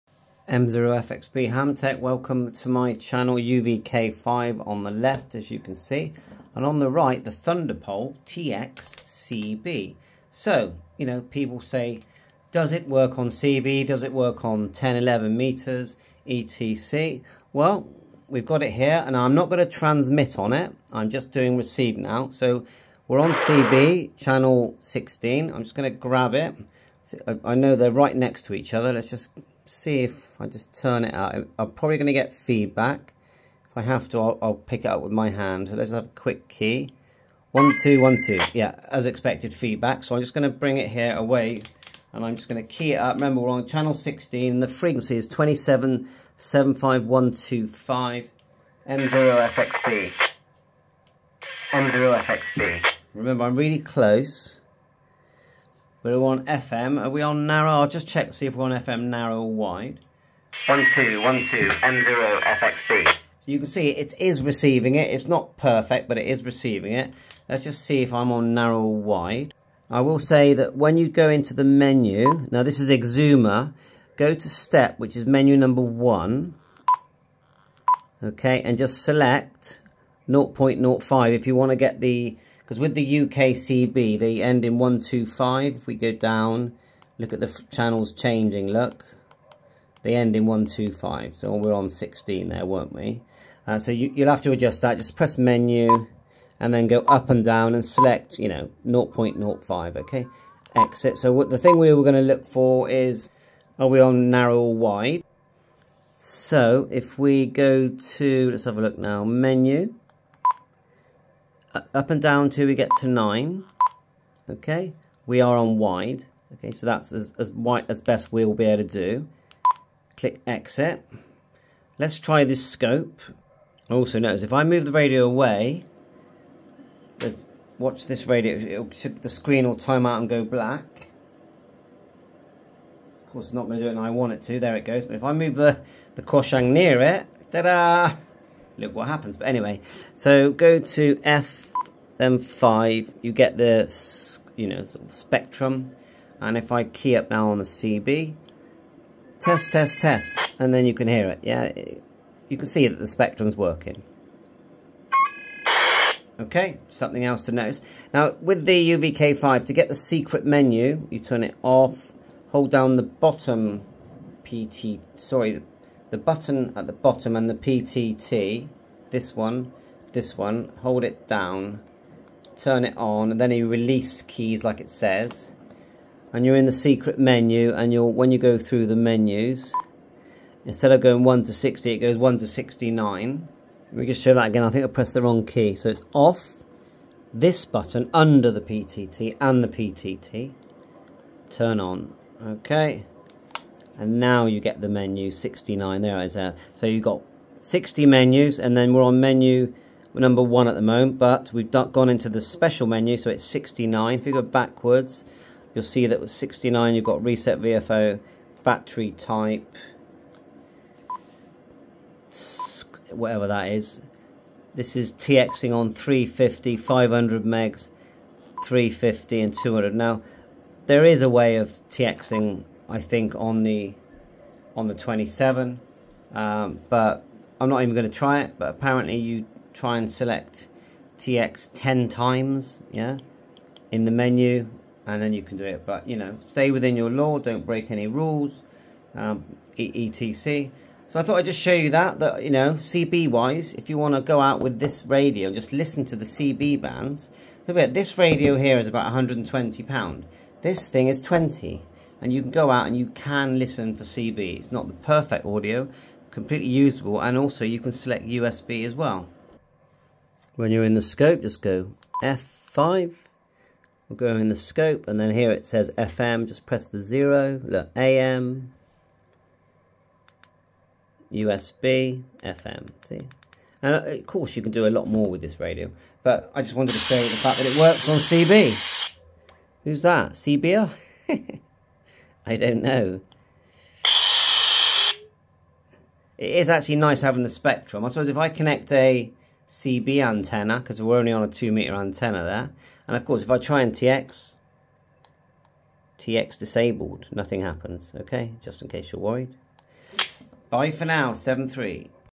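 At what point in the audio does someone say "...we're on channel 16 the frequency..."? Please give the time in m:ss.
0:43.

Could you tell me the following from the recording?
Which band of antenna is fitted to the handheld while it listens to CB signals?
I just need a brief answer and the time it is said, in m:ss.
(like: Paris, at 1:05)
2 meter, at 4:51.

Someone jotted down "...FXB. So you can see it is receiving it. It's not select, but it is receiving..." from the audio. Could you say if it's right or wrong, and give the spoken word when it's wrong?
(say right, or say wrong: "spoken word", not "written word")
wrong: "perfect", not "select".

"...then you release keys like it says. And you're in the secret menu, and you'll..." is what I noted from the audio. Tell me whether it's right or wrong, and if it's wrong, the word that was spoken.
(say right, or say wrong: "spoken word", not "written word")
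right.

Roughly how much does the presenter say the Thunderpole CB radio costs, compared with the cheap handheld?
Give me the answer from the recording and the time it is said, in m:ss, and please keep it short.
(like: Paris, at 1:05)
£120, at 4:08.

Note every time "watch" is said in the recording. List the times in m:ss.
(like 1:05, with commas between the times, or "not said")
2:07.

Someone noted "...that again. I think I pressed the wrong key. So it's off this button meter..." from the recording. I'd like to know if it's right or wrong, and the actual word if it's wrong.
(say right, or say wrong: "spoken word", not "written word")
wrong: "under", not "meter".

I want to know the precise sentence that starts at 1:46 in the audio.
So if we go to, let's have a look now, menu, up and down till we get to 9.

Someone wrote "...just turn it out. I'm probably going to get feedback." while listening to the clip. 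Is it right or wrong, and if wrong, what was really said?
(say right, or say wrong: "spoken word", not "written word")
right.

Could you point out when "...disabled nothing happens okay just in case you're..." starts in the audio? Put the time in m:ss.
4:56.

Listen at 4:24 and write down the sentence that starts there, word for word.
We'll go in the scope, and then here it says FM, just press the zero, look, AM, USB, FM, see?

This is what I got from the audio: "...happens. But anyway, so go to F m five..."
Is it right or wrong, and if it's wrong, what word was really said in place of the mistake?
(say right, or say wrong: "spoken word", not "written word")
right.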